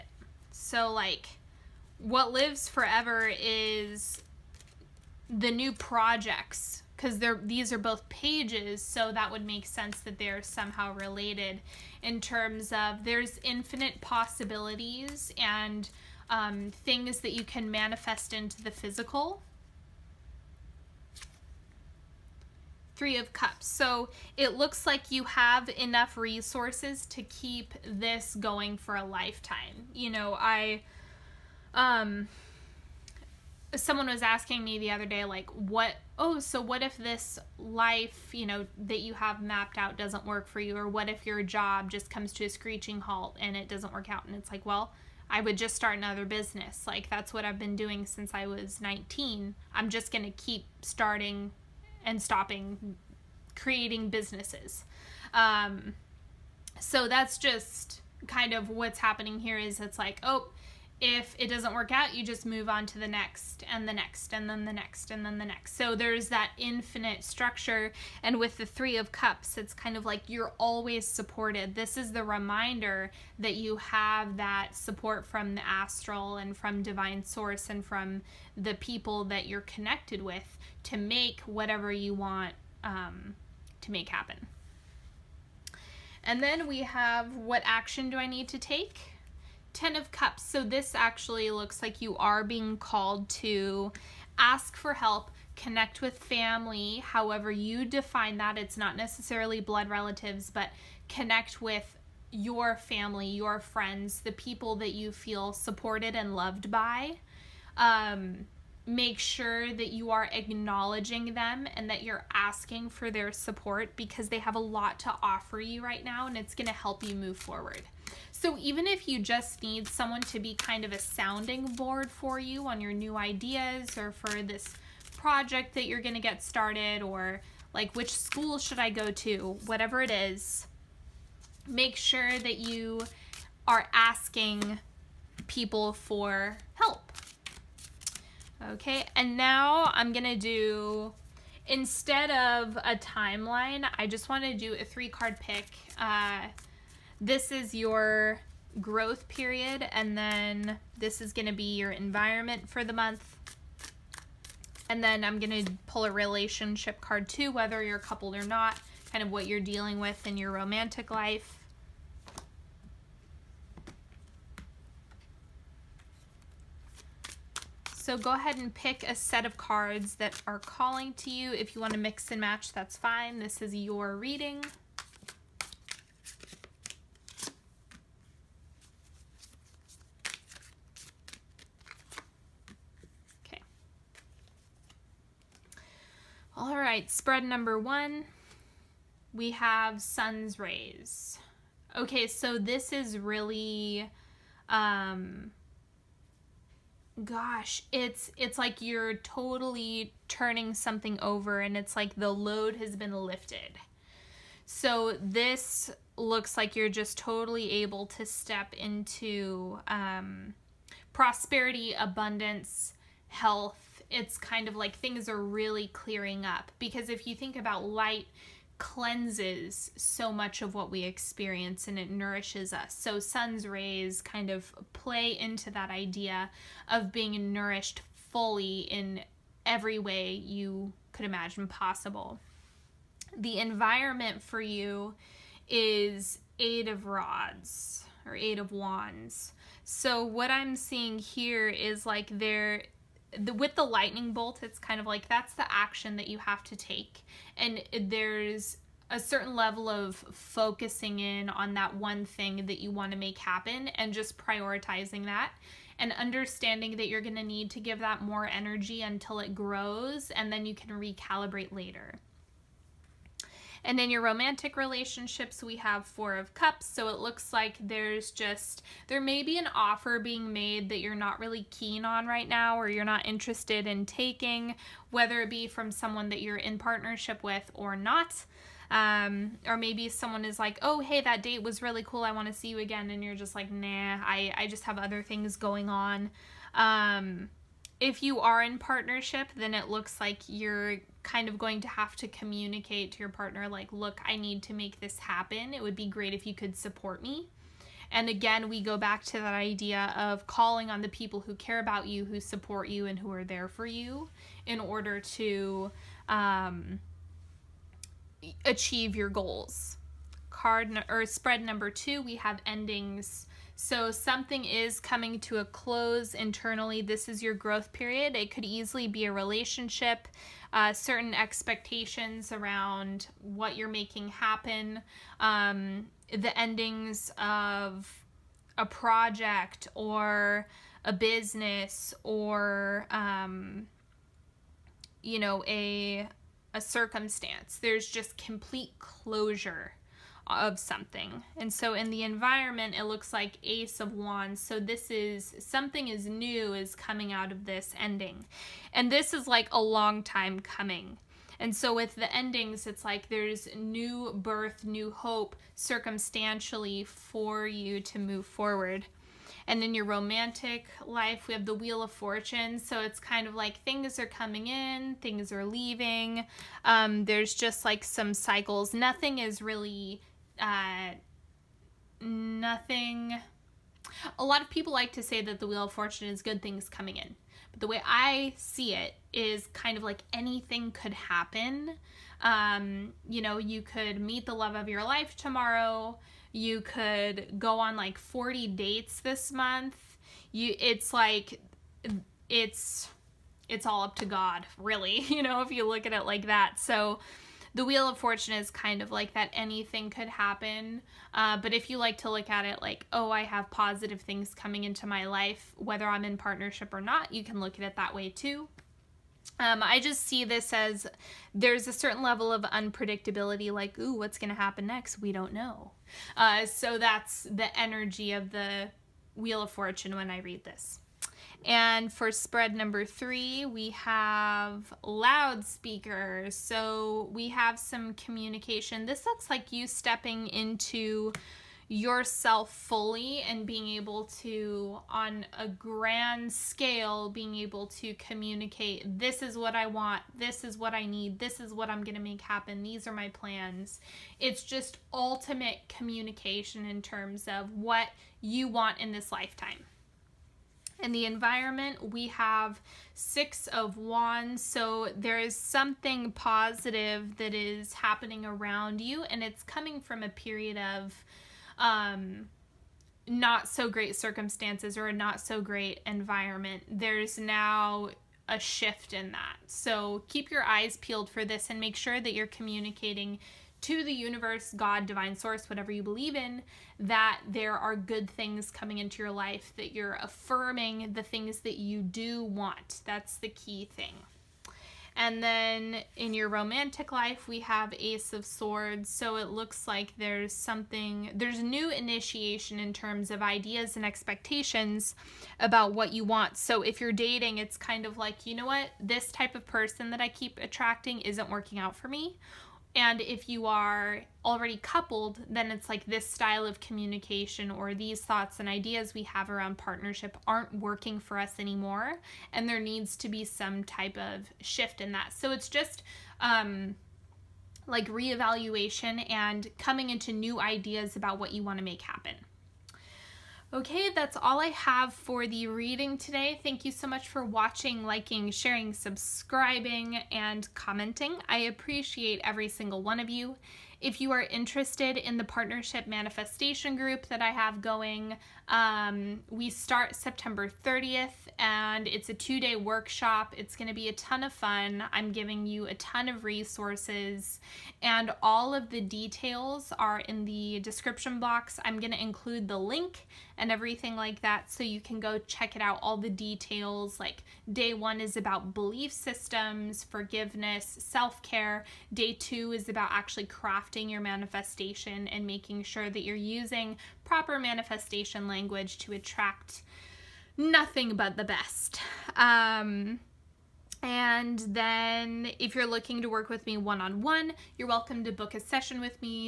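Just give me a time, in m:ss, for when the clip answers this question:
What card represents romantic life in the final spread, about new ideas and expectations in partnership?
8:07.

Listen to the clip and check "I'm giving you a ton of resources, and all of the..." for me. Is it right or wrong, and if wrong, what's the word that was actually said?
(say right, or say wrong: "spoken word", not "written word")
right.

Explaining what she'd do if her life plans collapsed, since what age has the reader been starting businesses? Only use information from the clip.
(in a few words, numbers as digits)
19.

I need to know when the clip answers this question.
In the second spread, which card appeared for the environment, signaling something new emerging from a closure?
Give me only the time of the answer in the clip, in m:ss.
5:43.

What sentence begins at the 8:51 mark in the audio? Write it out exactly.
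I appreciate every single one of you.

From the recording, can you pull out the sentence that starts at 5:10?
Card or spread number two, we have endings so something is coming to a close internally.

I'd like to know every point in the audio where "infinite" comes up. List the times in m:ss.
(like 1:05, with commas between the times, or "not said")
0:13, 1:06.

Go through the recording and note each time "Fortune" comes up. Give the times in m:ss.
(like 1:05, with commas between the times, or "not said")
6:02, 6:15, 6:38, 6:59.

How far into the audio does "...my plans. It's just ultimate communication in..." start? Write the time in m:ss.
7:23.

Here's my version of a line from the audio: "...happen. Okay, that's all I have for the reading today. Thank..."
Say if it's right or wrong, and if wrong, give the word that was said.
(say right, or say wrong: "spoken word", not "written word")
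right.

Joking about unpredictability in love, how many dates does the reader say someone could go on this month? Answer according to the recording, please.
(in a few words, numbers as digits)
40.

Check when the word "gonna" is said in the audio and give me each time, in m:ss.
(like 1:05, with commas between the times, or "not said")
2:20, 2:31, 2:35.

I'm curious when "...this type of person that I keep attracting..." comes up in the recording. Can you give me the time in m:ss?
8:19.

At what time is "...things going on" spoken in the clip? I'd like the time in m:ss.
4:45.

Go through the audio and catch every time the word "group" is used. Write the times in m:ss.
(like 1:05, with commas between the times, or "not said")
8:56.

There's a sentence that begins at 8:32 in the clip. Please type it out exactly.
And there needs to be some type of shift in that.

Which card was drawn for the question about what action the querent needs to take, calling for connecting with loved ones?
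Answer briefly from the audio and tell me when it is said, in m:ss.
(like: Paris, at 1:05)
Ten of Cups, at 1:29.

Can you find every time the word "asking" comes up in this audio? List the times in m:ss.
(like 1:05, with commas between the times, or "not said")
0:34, 1:52, 2:13.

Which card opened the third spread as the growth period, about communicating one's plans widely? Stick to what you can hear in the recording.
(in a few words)
Loudspeakers.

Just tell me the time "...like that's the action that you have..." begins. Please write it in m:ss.
4:05.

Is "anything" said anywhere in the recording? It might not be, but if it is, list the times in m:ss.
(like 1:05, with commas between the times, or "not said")
6:20, 6:39.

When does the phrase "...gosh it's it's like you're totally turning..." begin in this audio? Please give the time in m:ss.
3:17.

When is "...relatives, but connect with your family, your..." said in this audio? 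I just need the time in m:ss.
1:39.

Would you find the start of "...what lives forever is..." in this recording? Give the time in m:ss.
0:01.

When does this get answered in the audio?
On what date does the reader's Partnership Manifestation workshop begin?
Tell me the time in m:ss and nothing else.
9:00.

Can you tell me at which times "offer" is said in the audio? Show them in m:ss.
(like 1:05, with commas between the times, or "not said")
1:55, 4:29.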